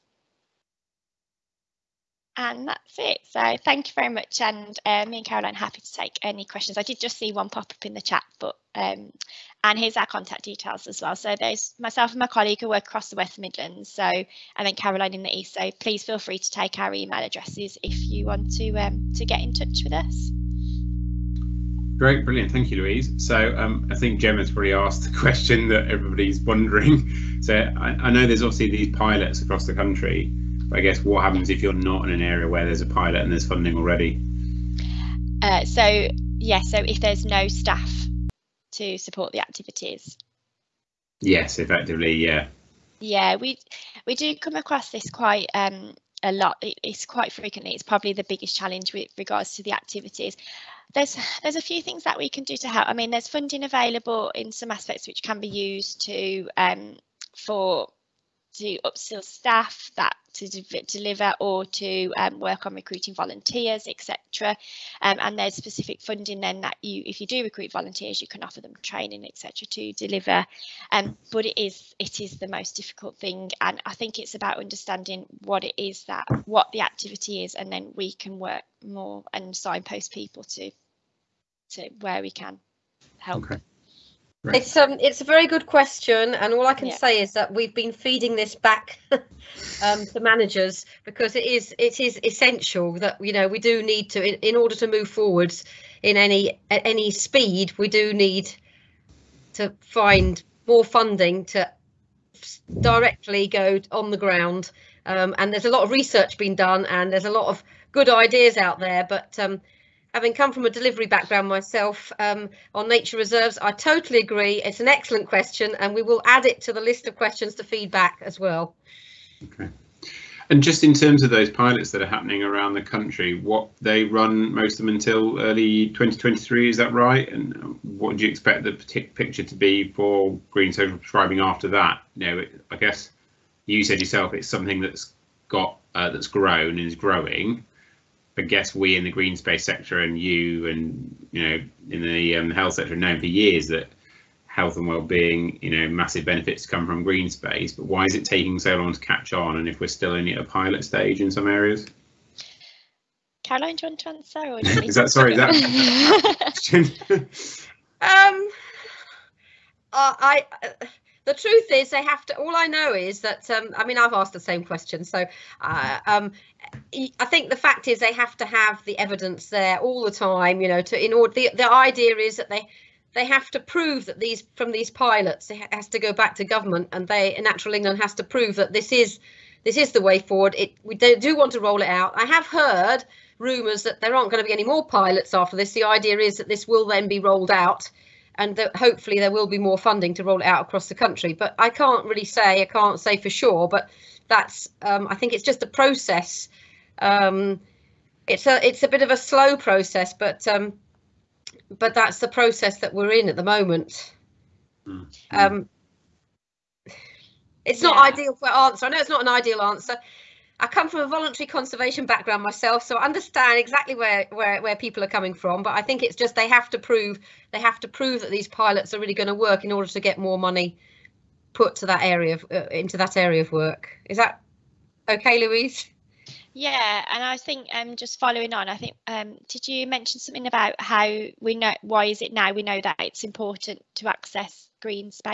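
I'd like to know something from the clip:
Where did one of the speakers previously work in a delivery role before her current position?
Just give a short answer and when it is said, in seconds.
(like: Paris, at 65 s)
nature reserves, at 112 s.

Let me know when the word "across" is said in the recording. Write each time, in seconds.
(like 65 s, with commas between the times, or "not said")
12 s, 29 s, 44 s, 190 s.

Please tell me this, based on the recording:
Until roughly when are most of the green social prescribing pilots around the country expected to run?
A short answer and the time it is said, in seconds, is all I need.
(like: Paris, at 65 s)
early 2023, at 125 s.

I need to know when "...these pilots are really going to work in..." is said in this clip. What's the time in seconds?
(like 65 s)
218 s.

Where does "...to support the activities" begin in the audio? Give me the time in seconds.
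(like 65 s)
38 s.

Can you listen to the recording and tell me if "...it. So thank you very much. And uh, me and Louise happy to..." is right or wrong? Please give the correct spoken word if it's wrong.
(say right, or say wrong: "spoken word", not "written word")
wrong: "Caroline", not "Louise".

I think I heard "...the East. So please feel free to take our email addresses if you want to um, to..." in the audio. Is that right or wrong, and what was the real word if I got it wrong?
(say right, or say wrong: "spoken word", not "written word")
right.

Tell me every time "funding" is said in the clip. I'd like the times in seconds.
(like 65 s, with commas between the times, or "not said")
33 s, 53 s, 66 s, 100 s, 189 s.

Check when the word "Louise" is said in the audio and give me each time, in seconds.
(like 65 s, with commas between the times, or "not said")
22 s, 225 s.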